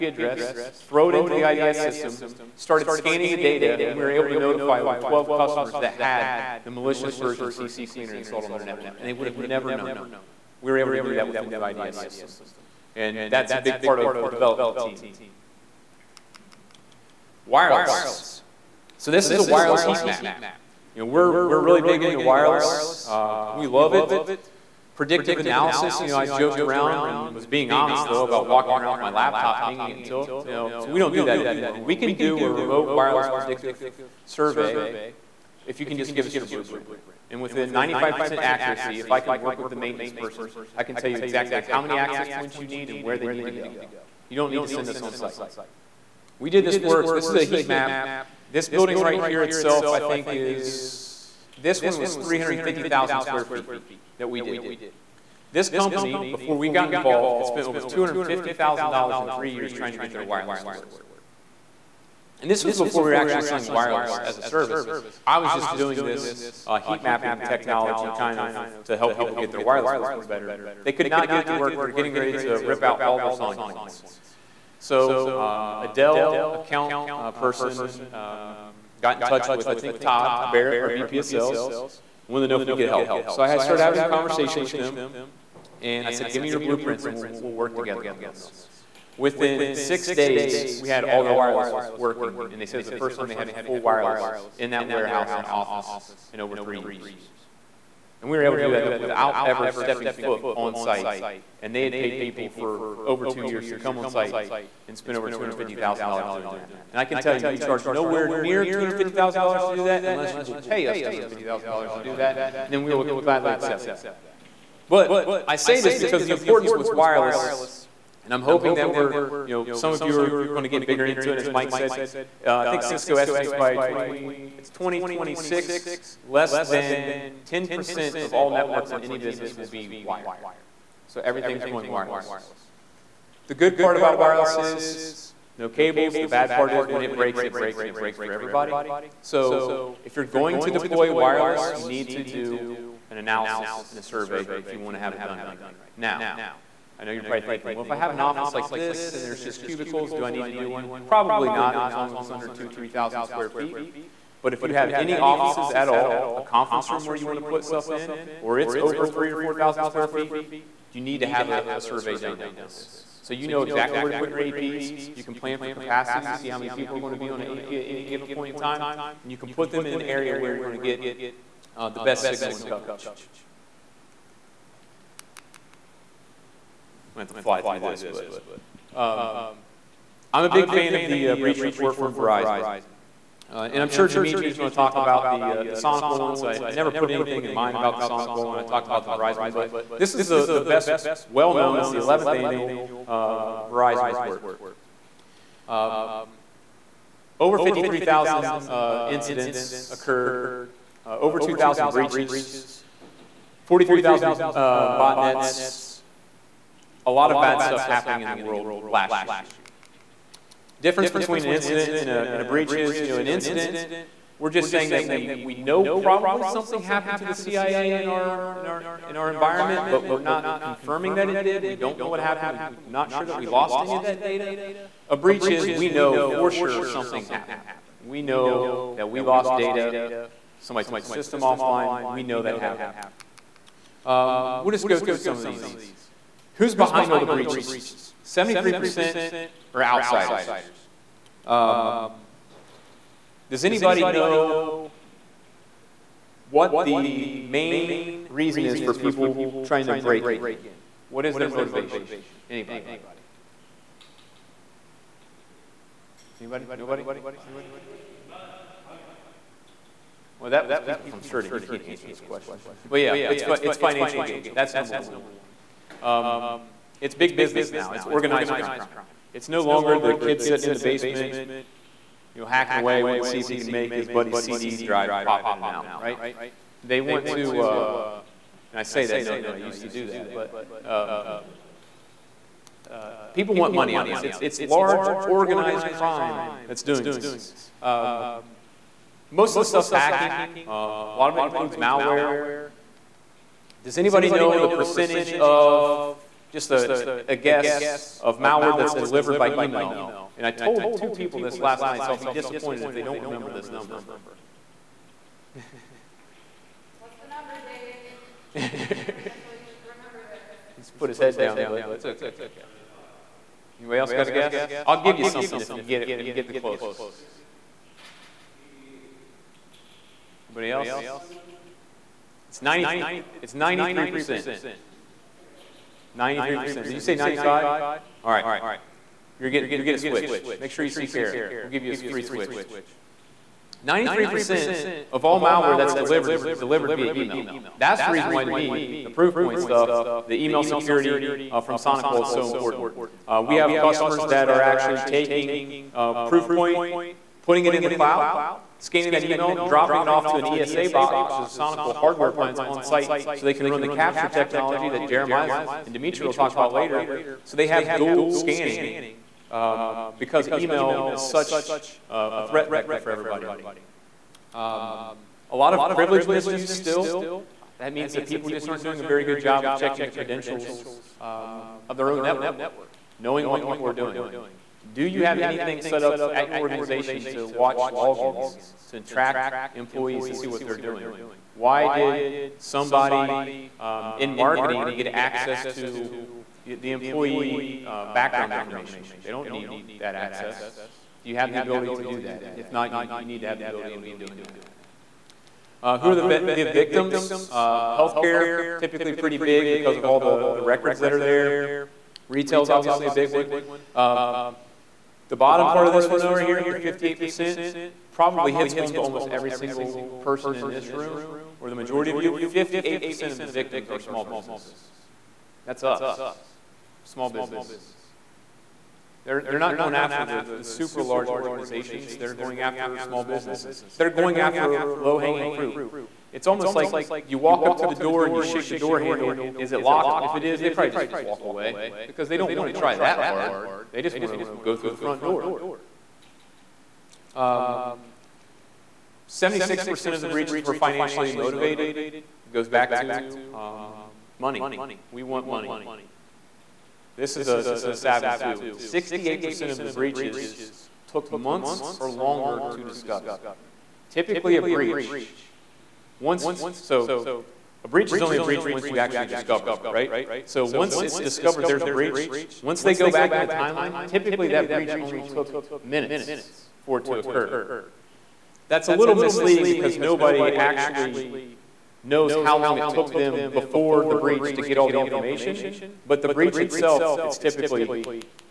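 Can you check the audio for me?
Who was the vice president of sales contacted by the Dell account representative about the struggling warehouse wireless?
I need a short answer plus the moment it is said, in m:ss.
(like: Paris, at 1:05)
Todd Barrett, at 1:19.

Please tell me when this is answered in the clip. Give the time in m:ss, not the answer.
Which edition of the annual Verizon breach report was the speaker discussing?
3:11.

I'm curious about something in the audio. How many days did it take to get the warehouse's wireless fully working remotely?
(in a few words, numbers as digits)
6.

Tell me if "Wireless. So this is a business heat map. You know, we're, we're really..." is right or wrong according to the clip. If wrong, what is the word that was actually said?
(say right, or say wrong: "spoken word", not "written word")
wrong: "wireless", not "business".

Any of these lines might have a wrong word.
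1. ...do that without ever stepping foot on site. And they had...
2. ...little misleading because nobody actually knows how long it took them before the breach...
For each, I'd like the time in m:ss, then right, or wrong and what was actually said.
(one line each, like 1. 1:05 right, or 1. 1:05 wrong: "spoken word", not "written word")
1. 1:38 right
2. 7:48 right.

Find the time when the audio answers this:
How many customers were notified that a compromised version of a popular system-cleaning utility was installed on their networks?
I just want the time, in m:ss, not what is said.
0:04.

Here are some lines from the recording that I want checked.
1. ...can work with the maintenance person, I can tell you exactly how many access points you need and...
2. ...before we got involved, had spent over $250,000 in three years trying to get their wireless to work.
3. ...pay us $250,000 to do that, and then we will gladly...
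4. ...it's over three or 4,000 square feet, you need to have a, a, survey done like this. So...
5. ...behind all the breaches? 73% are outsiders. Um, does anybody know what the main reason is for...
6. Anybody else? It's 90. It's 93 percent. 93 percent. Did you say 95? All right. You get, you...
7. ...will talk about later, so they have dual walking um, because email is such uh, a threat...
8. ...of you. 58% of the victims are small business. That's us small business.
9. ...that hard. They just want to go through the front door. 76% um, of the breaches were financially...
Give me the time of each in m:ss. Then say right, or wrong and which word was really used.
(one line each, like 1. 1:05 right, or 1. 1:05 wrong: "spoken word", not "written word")
1. 0:39 right
2. 0:56 right
3. 1:50 right
4. 2:38 right
5. 3:56 right
6. 5:20 right
7. 5:56 wrong: "scanning", not "walking"
8. 6:52 right
9. 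7:12 right.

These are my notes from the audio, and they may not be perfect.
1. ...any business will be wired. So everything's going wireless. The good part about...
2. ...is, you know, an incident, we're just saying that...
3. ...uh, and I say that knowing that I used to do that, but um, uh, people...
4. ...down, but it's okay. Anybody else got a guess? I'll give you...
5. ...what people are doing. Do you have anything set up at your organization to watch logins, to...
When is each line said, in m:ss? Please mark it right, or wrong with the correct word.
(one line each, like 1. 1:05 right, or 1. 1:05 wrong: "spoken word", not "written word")
1. 2:08 right
2. 3:32 right
3. 4:37 right
4. 5:11 right
5. 6:13 right.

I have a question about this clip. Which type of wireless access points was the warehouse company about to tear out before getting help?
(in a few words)
SonicPoints.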